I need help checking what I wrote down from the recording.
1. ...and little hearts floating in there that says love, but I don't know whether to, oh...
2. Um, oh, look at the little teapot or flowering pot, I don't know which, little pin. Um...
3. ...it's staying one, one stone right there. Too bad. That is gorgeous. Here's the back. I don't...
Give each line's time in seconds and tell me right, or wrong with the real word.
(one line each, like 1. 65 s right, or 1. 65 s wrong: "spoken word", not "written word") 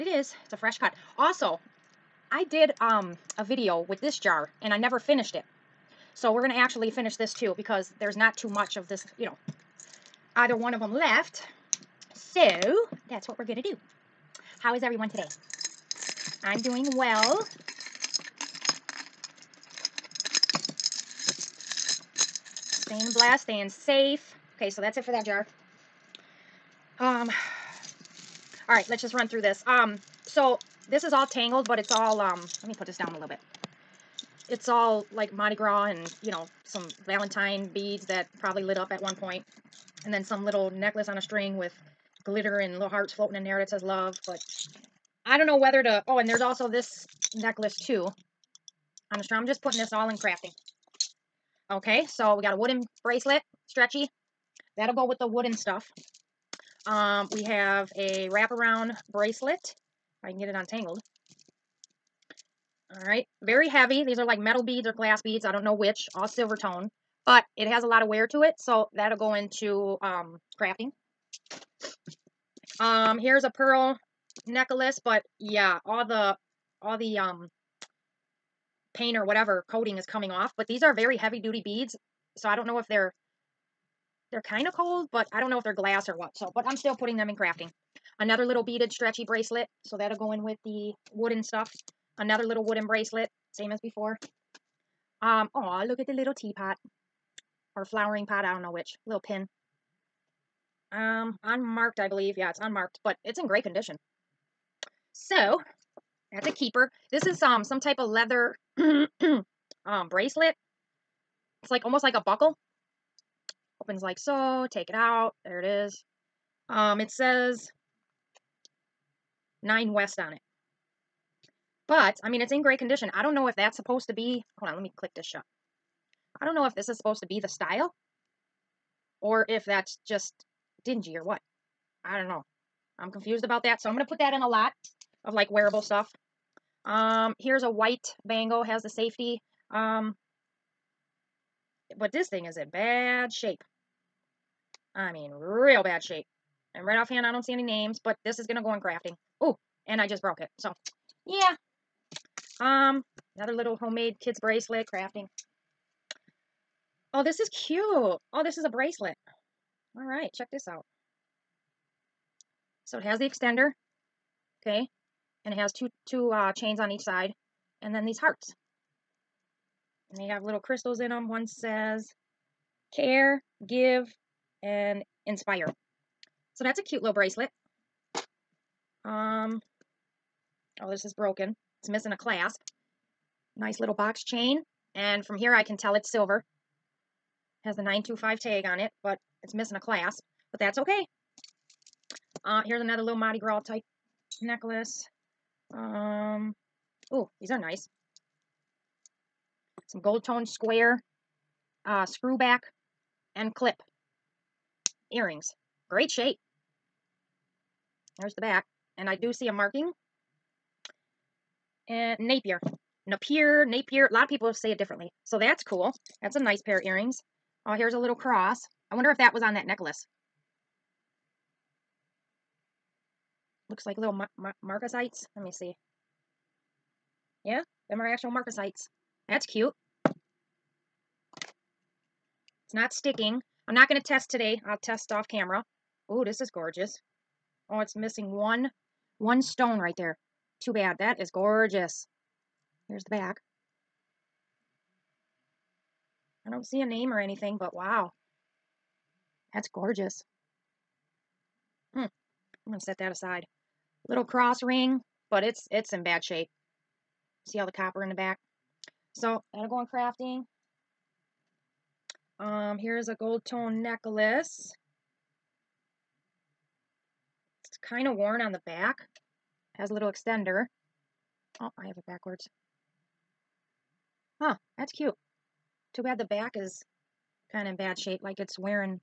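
1. 42 s right
2. 95 s right
3. 237 s wrong: "missing", not "staying".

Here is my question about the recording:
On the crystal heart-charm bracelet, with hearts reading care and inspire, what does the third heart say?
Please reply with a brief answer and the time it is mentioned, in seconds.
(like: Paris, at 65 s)
give, at 173 s.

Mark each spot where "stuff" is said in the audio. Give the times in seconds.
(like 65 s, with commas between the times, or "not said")
55 s, 91 s, 135 s.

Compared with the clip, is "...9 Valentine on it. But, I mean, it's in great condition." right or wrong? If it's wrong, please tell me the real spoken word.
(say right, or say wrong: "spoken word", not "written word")
wrong: "West", not "Valentine".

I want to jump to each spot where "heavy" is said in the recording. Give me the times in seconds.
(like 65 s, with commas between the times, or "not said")
63 s, 81 s.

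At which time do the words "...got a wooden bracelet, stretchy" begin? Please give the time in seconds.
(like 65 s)
52 s.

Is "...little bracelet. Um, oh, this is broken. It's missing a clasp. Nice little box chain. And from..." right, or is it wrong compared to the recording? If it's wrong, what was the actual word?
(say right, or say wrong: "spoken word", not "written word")
right.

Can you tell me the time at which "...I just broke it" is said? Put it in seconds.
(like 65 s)
149 s.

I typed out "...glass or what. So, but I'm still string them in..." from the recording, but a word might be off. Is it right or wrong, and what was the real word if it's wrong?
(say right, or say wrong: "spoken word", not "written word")
wrong: "putting", not "string".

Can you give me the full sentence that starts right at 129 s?
Or if that's just dingy or what.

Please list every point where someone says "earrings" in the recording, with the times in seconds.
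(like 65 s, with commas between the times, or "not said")
205 s, 216 s.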